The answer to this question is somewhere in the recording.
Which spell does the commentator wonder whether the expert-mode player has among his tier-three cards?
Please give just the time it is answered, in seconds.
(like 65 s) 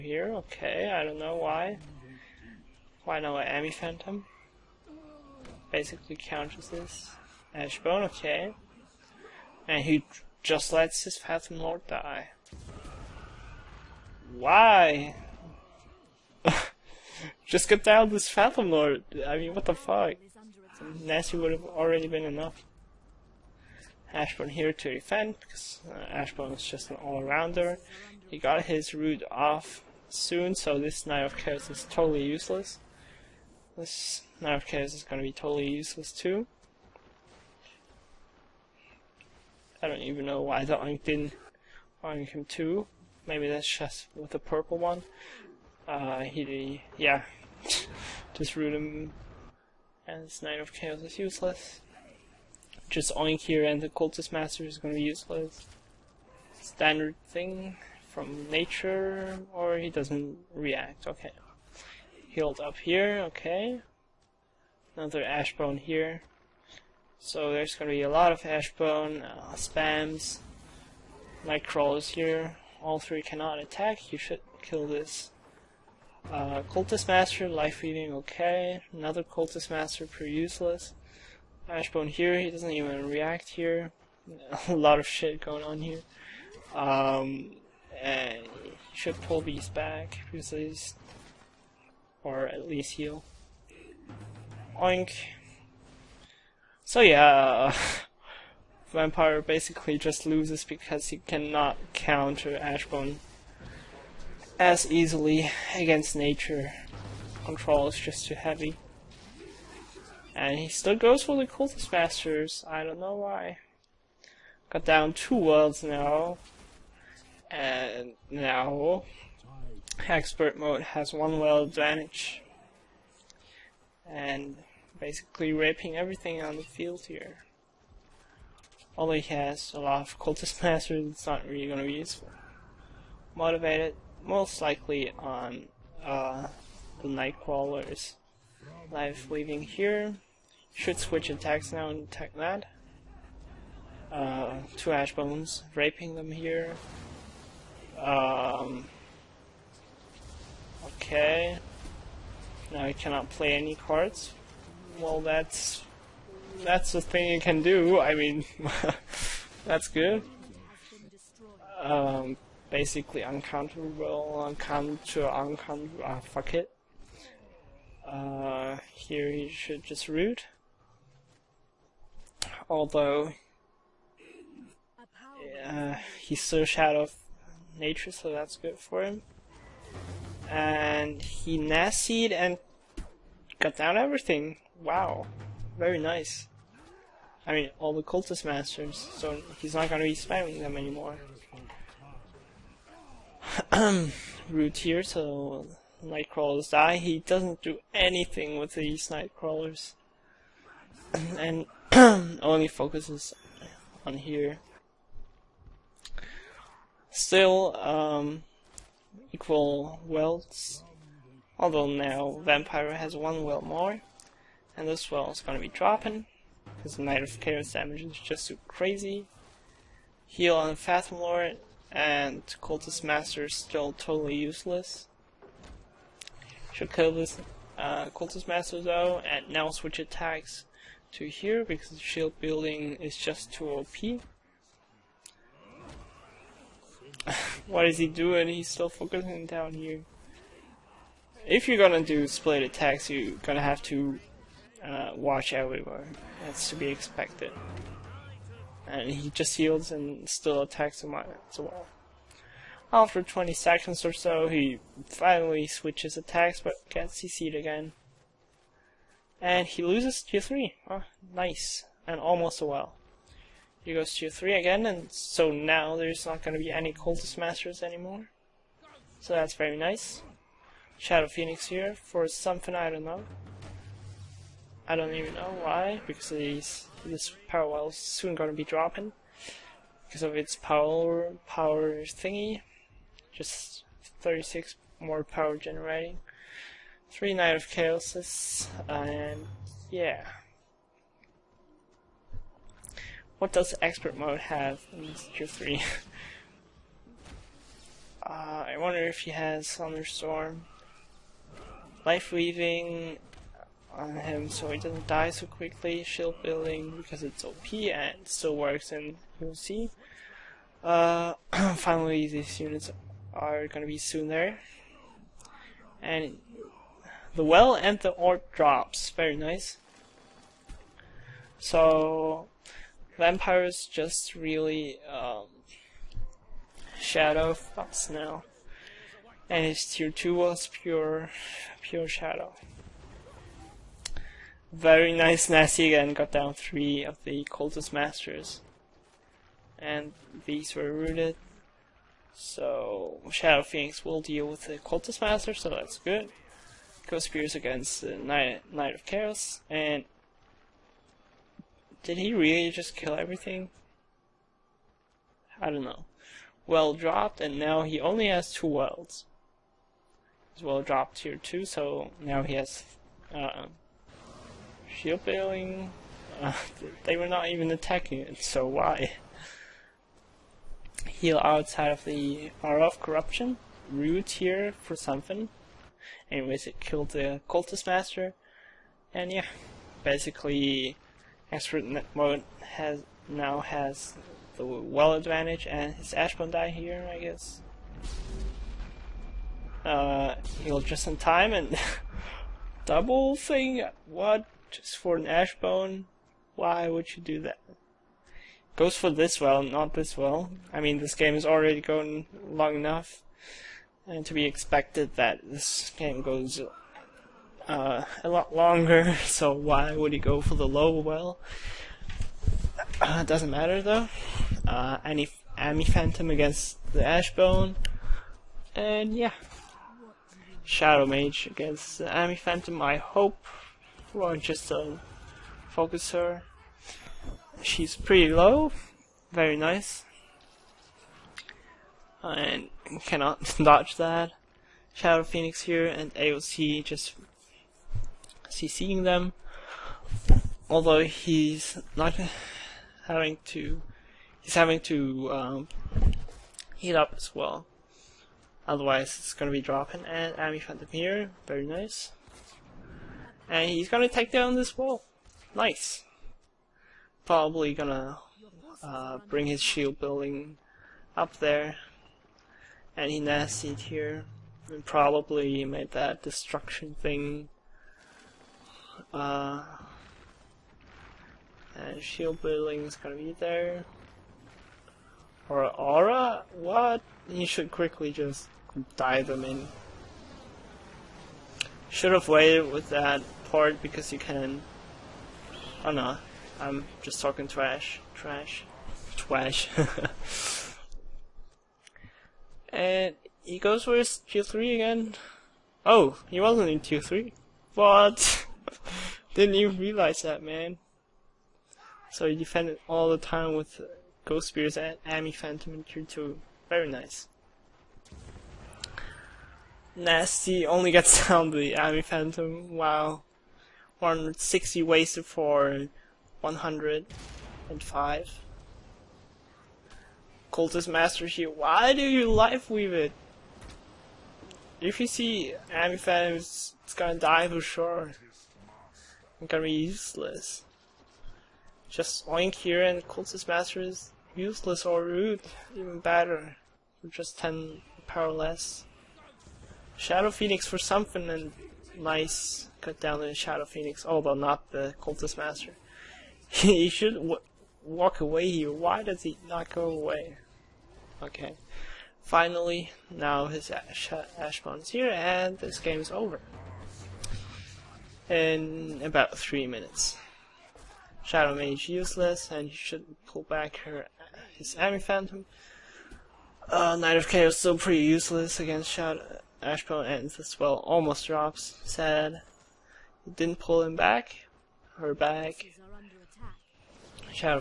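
299 s.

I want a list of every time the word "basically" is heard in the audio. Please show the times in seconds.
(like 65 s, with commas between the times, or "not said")
5 s, 99 s, 124 s, 162 s, 380 s.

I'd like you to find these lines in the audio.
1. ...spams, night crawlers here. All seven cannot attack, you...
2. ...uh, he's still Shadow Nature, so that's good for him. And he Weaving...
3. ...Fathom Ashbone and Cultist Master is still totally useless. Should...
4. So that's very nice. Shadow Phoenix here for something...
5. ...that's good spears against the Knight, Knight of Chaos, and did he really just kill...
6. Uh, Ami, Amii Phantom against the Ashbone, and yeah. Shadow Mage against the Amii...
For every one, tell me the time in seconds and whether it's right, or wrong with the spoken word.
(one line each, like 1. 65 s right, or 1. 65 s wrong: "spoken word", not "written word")
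1. 69 s wrong: "three", not "seven"
2. 175 s wrong: "Nasied", not "Weaving"
3. 220 s wrong: "Lord", not "Ashbone"
4. 269 s right
5. 345 s right
6. 414 s right.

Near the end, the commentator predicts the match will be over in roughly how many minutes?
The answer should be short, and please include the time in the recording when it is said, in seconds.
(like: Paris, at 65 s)
3, at 559 s.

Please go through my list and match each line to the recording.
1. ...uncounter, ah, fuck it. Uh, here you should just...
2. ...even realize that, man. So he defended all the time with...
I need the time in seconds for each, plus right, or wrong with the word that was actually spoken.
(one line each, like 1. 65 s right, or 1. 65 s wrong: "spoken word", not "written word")
1. 165 s right
2. 499 s right.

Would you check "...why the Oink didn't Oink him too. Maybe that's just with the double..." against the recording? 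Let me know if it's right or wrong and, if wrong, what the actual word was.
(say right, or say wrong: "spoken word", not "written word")
wrong: "purple", not "double".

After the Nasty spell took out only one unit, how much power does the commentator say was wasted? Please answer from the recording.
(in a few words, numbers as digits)
160.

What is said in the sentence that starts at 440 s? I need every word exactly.
Although he's not having to, he's having to um, heat up as well.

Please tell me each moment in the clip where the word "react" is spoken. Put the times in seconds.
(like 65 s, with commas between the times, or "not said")
60 s, 83 s.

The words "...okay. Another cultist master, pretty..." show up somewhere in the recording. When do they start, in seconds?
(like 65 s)
78 s.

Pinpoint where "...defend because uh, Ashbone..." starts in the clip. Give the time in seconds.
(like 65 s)
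24 s.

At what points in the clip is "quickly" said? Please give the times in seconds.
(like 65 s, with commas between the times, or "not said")
305 s, 477 s.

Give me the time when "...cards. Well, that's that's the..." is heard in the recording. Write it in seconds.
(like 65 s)
153 s.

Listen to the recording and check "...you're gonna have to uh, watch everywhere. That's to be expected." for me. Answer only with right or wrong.
right.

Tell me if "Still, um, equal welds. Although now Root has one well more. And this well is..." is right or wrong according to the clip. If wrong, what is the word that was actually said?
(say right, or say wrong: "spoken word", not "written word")
wrong: "Vampire", not "Root".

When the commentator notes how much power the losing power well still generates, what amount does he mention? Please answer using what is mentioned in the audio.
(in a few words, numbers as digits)
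36.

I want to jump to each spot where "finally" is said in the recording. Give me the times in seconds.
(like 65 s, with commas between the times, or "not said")
255 s, 311 s, 552 s.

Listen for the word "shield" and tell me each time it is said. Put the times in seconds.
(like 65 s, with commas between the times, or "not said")
231 s, 306 s, 364 s, 459 s, 472 s.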